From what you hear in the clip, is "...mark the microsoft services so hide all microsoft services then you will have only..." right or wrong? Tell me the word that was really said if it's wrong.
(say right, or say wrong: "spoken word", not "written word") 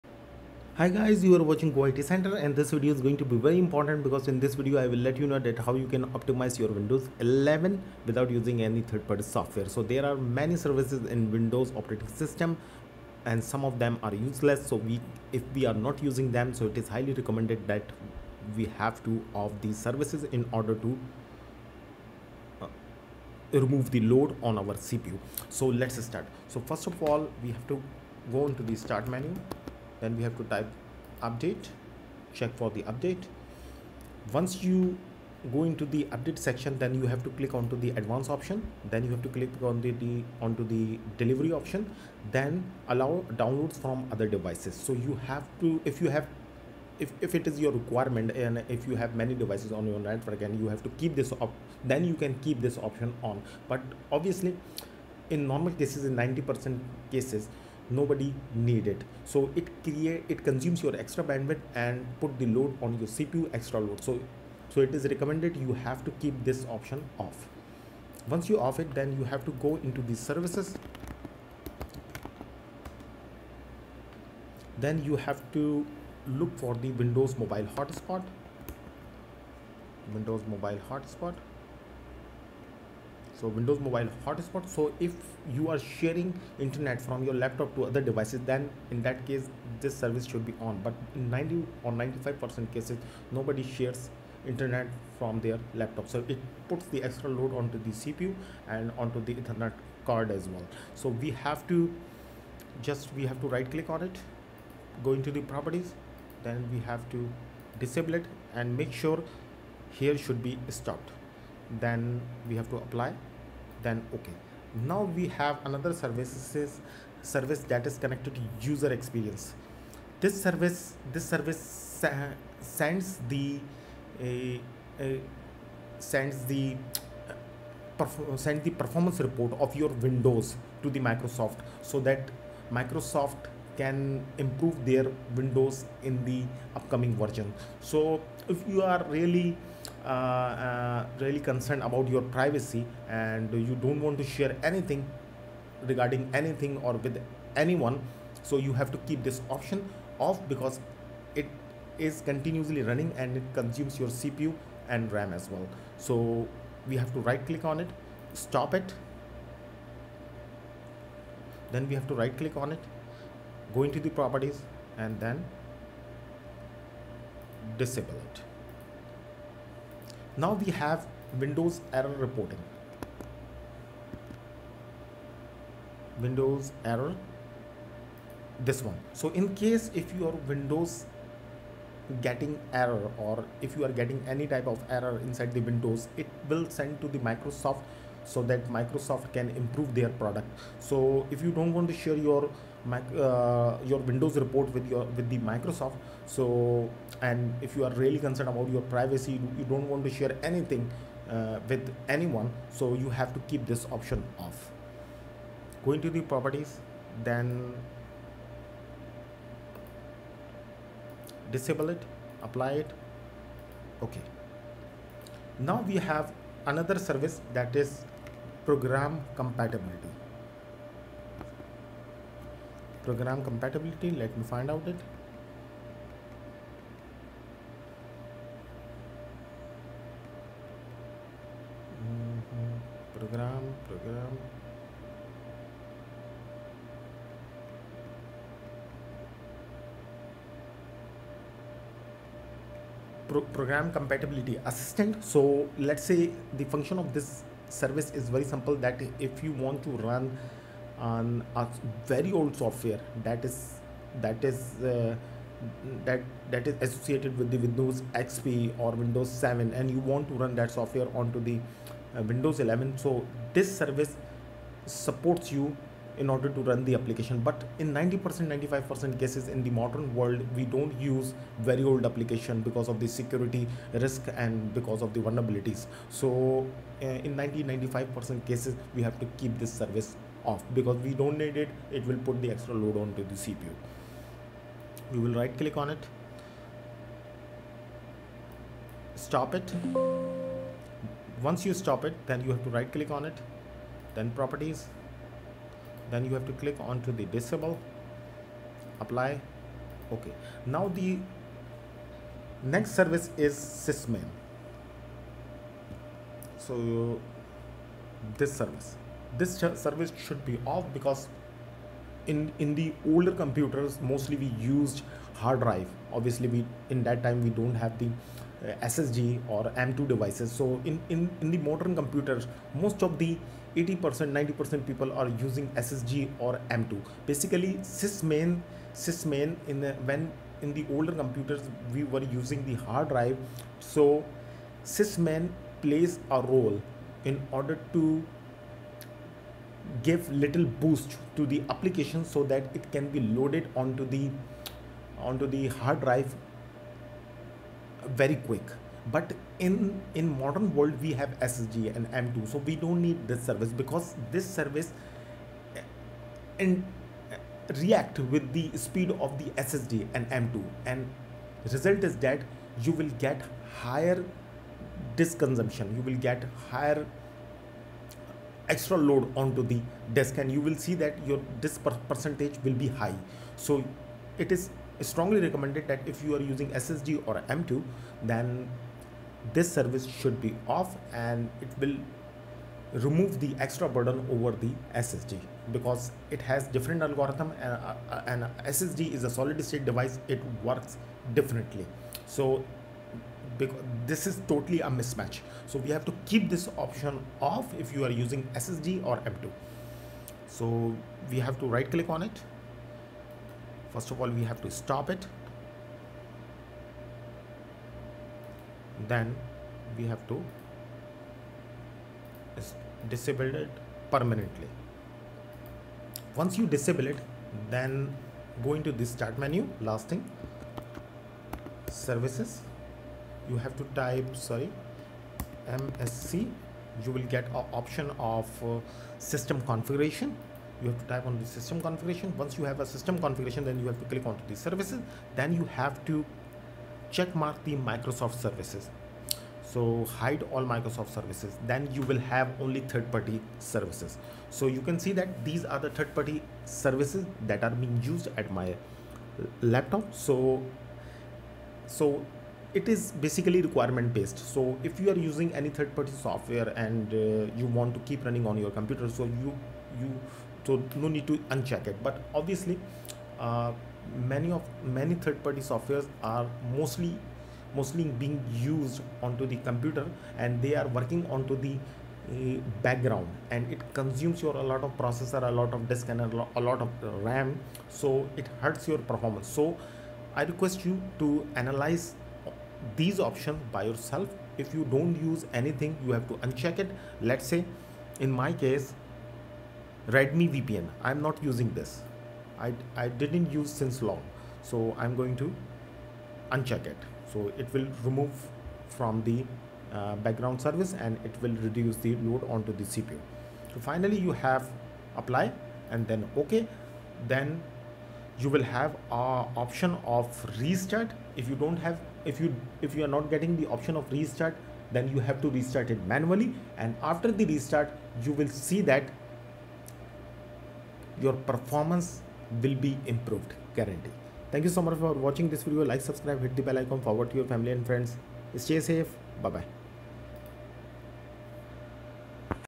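right.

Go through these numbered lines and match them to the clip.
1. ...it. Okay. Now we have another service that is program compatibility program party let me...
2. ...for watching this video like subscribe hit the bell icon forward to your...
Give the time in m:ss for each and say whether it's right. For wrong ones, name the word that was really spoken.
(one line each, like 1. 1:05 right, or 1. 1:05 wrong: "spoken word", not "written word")
1. 3:32 wrong: "compatibility", not "party"
2. 8:44 right.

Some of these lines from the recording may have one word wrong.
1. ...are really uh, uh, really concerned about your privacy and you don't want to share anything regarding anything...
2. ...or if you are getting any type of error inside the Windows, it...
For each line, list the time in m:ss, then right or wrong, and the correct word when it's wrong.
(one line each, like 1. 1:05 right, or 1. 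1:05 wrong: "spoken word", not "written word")
1. 2:18 right
2. 3:03 right.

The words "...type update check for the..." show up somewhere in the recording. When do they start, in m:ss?
0:30.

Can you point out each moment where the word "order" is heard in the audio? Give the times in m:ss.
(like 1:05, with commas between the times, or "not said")
0:20, 4:26, 5:37.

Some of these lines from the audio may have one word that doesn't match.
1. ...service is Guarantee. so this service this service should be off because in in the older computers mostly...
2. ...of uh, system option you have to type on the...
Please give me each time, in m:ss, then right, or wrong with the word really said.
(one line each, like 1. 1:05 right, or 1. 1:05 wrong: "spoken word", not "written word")
1. 5:02 wrong: "SysMain", not "Guarantee"
2. 7:08 wrong: "configuration", not "option".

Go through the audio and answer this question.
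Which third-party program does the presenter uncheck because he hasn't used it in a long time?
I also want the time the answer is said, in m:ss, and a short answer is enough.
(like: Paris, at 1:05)
Radmin VPN, at 8:10.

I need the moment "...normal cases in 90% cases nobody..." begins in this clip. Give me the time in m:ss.
0:55.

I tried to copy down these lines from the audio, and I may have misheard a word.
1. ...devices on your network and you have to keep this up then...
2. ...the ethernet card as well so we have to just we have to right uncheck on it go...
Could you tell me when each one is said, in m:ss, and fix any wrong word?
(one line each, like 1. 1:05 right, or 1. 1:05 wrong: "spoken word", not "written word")
1. 0:49 right
2. 1:39 wrong: "click", not "uncheck".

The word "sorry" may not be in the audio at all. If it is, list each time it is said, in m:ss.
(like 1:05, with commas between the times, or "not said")
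7:04.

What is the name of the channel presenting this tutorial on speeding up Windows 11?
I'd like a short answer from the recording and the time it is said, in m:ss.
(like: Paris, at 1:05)
Go IT Center, at 0:01.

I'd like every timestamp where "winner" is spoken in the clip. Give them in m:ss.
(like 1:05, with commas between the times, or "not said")
not said.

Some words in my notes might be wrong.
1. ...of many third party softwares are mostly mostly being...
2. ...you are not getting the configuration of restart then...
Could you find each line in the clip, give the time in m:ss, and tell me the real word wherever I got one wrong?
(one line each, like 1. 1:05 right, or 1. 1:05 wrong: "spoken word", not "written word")
1. 7:44 right
2. 8:32 wrong: "option", not "configuration".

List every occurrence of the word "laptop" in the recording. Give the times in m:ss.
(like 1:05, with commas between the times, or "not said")
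1:27, 1:35, 7:29.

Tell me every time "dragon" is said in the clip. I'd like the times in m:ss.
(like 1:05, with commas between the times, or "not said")
not said.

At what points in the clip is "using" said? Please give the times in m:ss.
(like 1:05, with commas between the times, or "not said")
0:08, 0:16, 5:25, 5:32, 6:16, 6:38, 7:35, 8:11.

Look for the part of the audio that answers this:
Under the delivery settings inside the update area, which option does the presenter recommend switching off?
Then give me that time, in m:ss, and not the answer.
0:42.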